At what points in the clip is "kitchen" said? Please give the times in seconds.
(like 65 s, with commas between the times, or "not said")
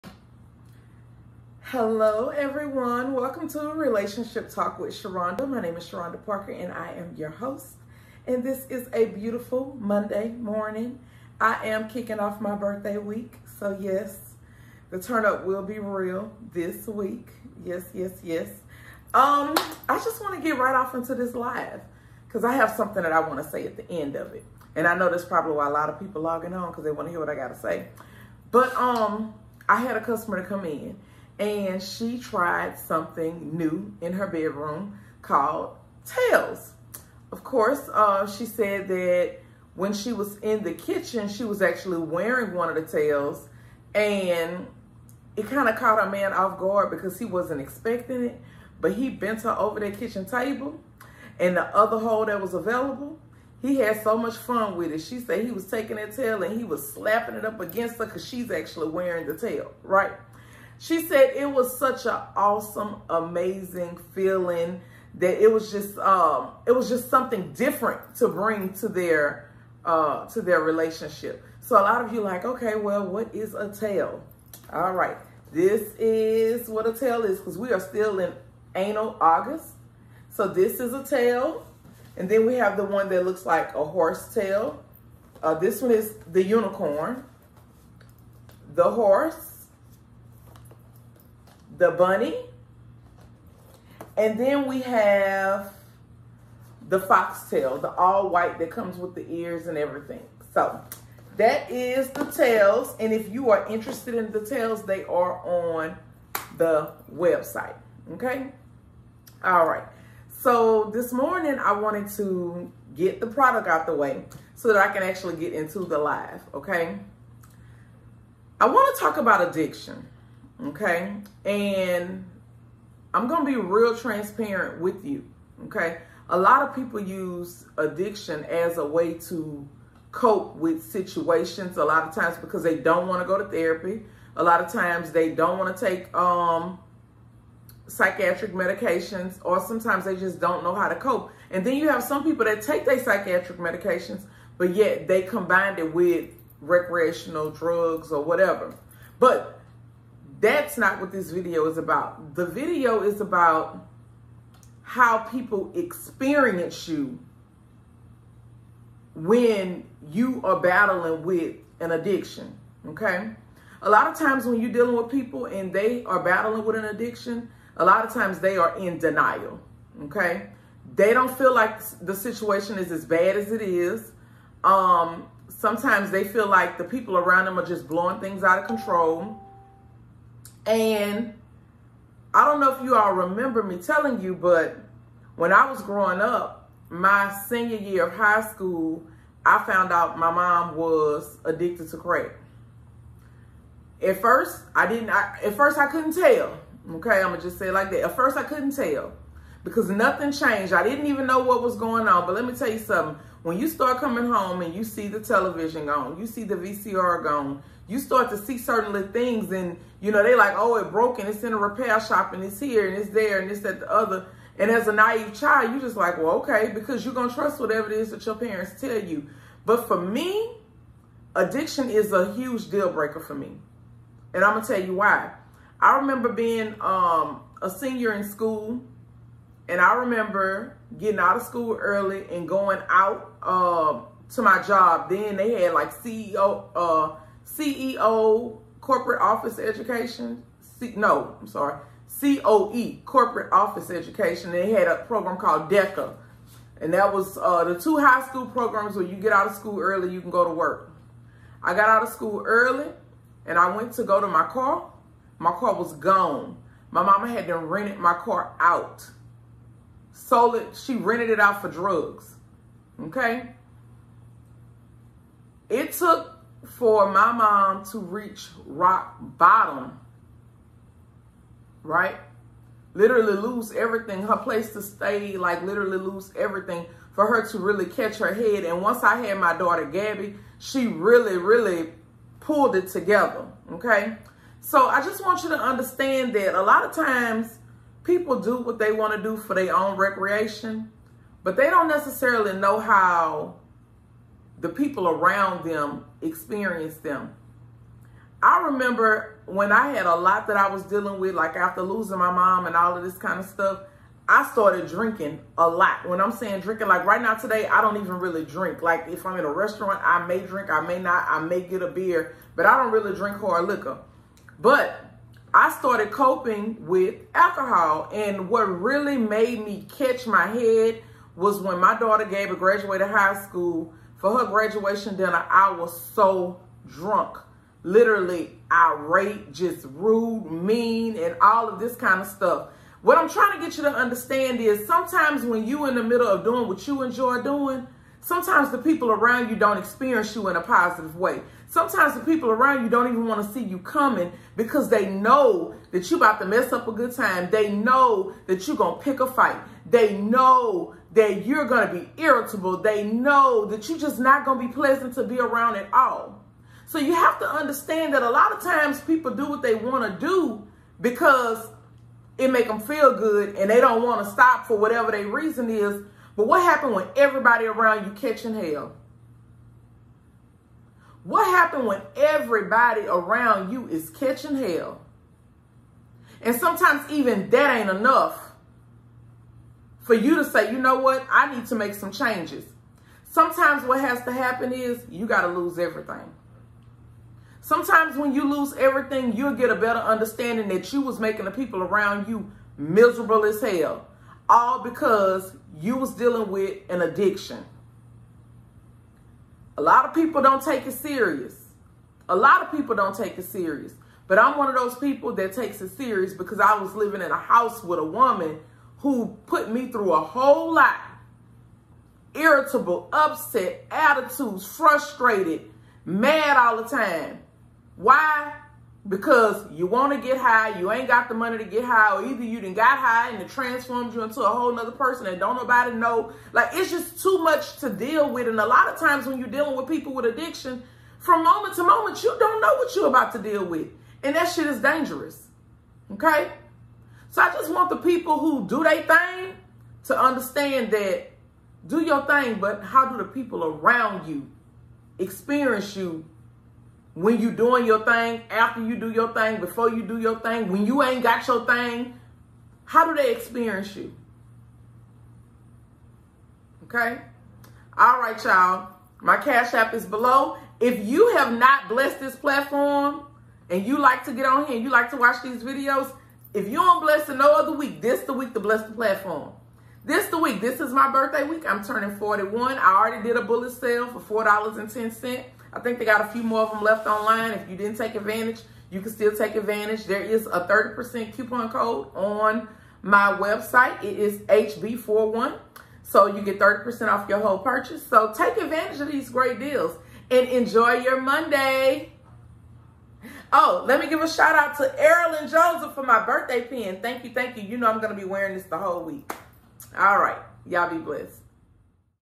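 40 s, 49 s.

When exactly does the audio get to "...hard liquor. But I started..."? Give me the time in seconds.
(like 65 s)
313 s.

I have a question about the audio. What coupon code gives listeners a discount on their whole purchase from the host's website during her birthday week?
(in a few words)
HB41.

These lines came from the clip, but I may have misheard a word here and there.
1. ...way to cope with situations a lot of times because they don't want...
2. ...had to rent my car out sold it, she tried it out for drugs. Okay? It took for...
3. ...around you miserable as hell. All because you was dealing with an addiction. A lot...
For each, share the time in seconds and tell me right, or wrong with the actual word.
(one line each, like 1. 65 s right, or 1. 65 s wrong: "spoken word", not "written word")
1. 128 s right
2. 257 s wrong: "rented", not "tried"
3. 391 s right.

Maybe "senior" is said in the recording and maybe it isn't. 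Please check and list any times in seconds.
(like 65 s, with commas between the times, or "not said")
187 s, 227 s.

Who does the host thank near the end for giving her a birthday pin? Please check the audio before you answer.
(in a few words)
Erilyn Joseph.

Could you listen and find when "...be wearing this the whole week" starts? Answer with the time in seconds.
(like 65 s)
498 s.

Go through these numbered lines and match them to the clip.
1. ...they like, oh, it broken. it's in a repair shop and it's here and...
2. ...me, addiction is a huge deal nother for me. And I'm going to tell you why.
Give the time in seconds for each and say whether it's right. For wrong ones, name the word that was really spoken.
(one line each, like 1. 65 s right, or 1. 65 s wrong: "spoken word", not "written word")
1. 210 s right
2. 219 s wrong: "breaker", not "nother".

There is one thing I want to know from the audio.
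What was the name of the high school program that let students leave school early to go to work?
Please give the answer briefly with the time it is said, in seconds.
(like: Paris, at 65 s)
DECA, at 245 s.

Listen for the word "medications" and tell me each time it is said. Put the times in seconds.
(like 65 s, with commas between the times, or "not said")
138 s, 143 s.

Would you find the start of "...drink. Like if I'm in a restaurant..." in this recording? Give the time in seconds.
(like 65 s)
308 s.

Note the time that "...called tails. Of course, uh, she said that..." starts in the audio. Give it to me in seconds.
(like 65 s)
35 s.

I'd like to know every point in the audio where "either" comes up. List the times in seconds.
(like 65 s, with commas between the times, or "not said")
422 s.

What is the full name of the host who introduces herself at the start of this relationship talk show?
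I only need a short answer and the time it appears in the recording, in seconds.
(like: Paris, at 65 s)
Sharonda Parker, at 5 s.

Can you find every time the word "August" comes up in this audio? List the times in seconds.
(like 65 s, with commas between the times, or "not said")
79 s.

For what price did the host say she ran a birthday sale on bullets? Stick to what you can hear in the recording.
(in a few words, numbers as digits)
$4.10.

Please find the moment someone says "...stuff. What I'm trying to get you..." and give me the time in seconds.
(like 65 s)
332 s.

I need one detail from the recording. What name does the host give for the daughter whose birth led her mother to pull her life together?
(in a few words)
Gabby.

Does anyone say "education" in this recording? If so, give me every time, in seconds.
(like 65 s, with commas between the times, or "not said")
239 s, 243 s.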